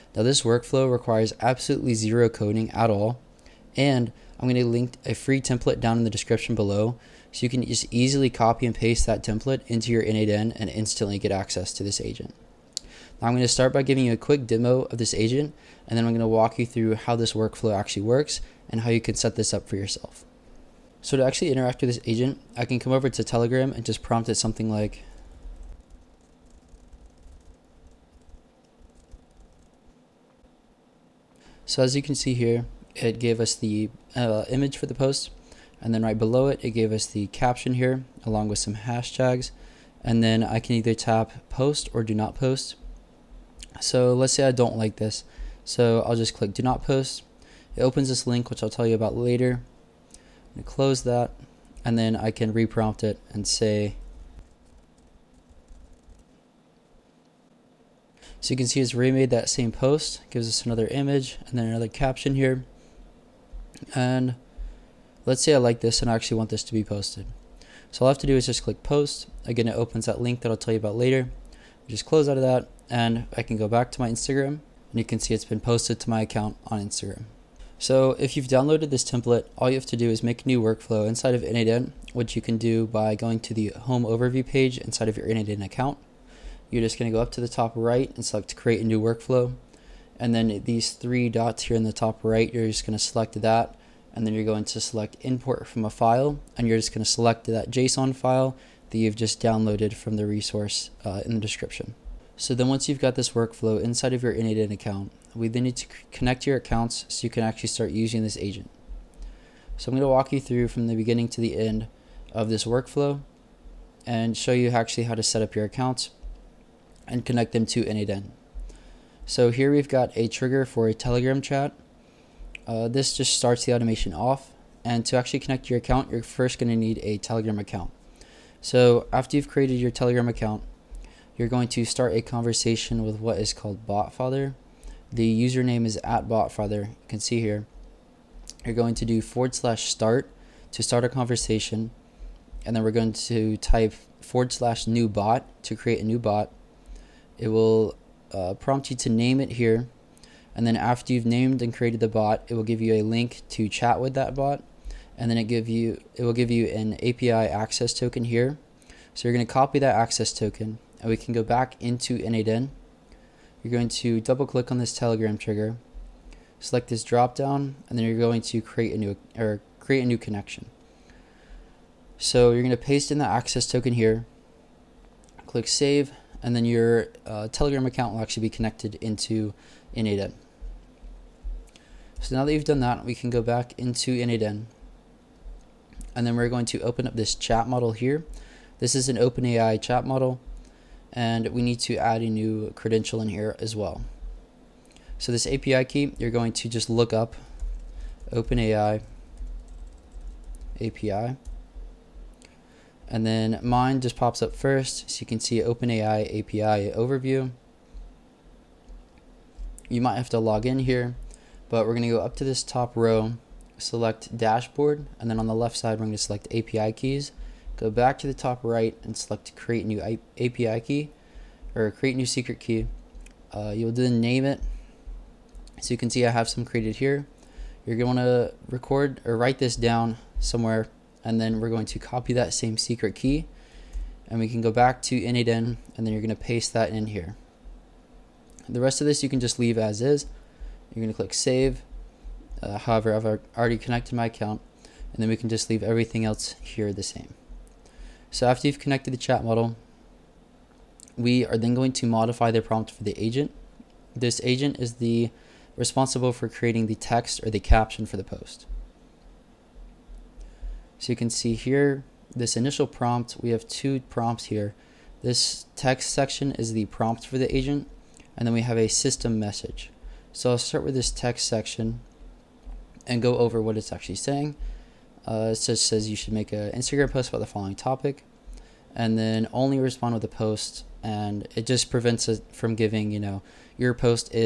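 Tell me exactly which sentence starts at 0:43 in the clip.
So let's say I don't like this.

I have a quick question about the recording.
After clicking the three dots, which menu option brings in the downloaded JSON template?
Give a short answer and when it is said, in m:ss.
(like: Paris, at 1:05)
Import from a file, at 1:35.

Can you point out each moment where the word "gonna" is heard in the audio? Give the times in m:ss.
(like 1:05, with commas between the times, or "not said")
3:31, 3:36.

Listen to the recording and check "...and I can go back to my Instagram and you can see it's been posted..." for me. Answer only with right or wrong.
right.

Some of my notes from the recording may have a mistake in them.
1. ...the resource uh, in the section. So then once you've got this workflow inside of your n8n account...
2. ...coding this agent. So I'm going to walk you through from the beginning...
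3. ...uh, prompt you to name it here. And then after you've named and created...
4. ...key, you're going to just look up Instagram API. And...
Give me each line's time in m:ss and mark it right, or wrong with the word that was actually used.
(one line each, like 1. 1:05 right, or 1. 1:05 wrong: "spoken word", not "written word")
1. 1:40 wrong: "description", not "section"
2. 1:47 wrong: "using", not "coding"
3. 2:28 right
4. 3:15 wrong: "OpenAI", not "Instagram".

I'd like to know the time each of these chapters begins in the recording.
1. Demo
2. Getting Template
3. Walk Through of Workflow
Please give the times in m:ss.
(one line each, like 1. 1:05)
1. 0:20
2. 1:18
3. 1:43.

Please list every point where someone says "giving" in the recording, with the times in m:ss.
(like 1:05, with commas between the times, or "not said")
0:13, 4:42.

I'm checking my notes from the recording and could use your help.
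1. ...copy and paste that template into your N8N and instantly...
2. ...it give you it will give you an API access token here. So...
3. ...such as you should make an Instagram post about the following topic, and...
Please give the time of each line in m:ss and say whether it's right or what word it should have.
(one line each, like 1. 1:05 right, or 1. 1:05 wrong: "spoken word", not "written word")
1. 0:08 right
2. 2:35 right
3. 4:35 right.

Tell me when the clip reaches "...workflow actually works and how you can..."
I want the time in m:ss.
0:17.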